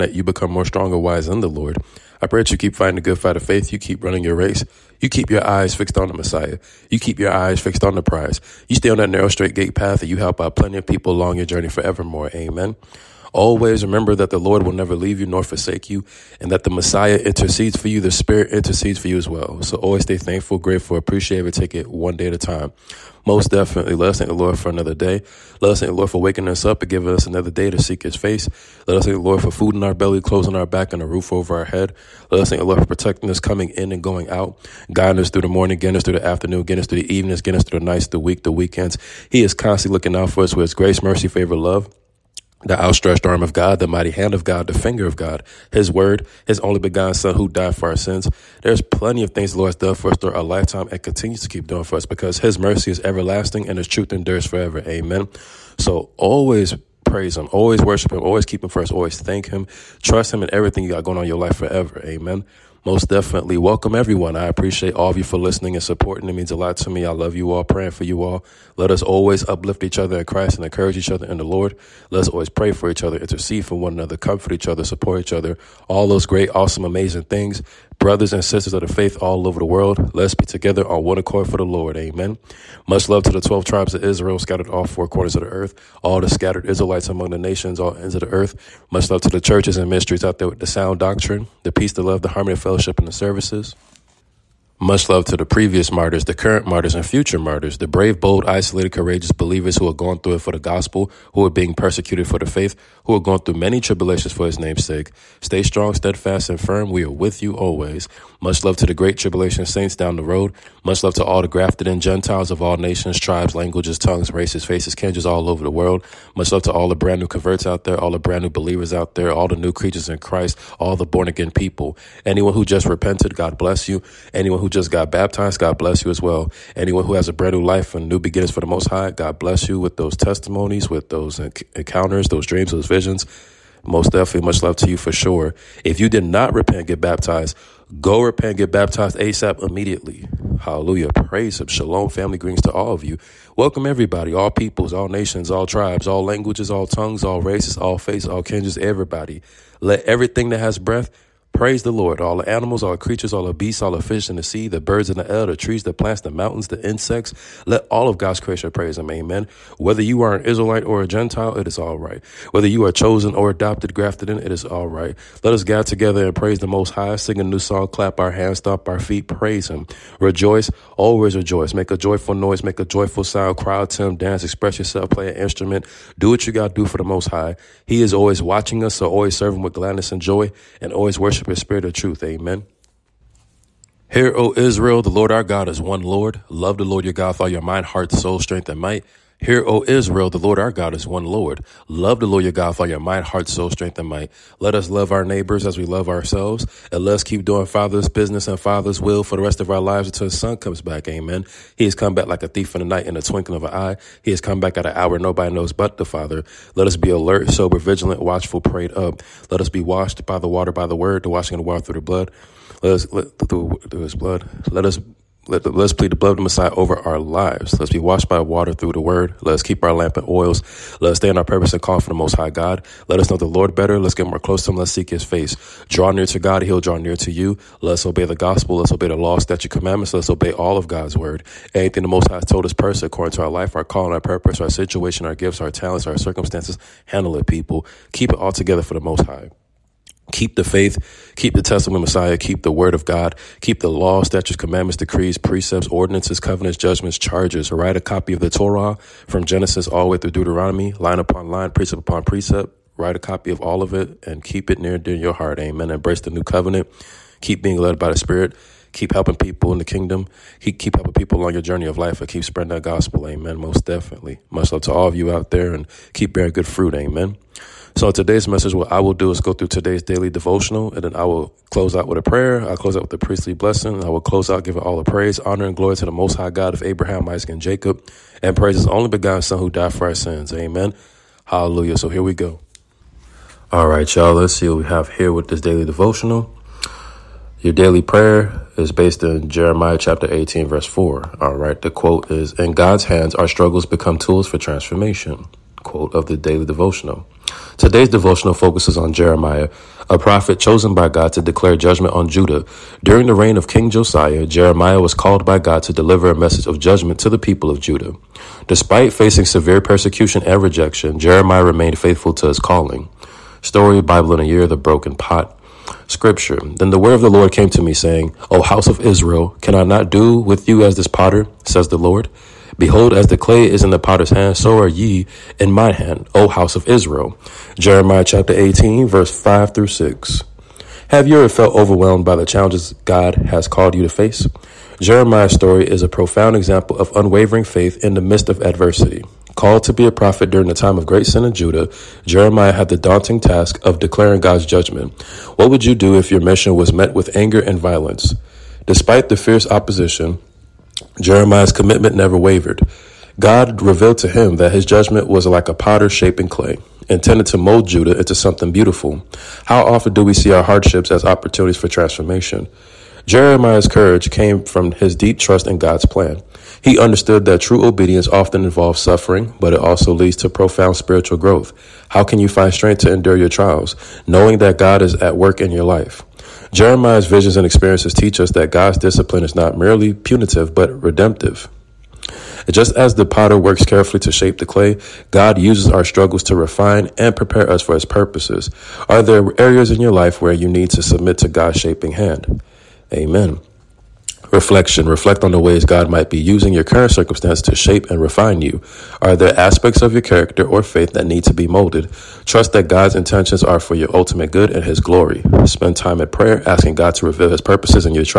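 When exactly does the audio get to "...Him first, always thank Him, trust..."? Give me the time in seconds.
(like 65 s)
58 s.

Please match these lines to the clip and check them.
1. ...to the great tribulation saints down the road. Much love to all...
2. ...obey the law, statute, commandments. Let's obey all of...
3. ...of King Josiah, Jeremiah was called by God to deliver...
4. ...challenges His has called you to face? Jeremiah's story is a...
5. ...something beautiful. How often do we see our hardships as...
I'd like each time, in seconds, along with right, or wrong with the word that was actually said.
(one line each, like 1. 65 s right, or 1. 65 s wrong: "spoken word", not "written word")
1. 108 s right
2. 228 s right
3. 303 s right
4. 332 s wrong: "God", not "His"
5. 358 s right.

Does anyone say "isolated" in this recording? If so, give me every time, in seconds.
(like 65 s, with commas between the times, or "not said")
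98 s.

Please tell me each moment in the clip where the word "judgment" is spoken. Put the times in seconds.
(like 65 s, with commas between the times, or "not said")
246 s, 301 s, 306 s, 344 s, 354 s.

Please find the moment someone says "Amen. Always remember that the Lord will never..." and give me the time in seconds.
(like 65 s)
12 s.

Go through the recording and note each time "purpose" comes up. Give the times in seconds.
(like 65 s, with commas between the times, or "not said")
221 s, 234 s, 388 s, 407 s.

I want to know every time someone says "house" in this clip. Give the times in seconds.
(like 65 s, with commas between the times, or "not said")
318 s, 326 s.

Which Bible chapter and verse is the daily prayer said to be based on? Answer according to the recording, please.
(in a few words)
Jeremiah 18:4.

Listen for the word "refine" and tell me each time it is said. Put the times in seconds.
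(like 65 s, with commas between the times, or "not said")
386 s, 398 s.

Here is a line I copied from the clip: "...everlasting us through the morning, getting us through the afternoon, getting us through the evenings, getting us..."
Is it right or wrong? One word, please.
wrong.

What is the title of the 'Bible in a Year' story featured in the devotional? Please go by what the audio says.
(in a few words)
The Broken Pot.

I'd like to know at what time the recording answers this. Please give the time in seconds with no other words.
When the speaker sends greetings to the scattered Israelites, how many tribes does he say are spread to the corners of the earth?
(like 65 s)
83 s.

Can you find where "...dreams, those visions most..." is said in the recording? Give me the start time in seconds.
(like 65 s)
132 s.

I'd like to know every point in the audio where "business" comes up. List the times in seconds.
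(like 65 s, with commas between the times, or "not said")
198 s.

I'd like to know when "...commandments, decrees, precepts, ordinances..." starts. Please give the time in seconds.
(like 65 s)
244 s.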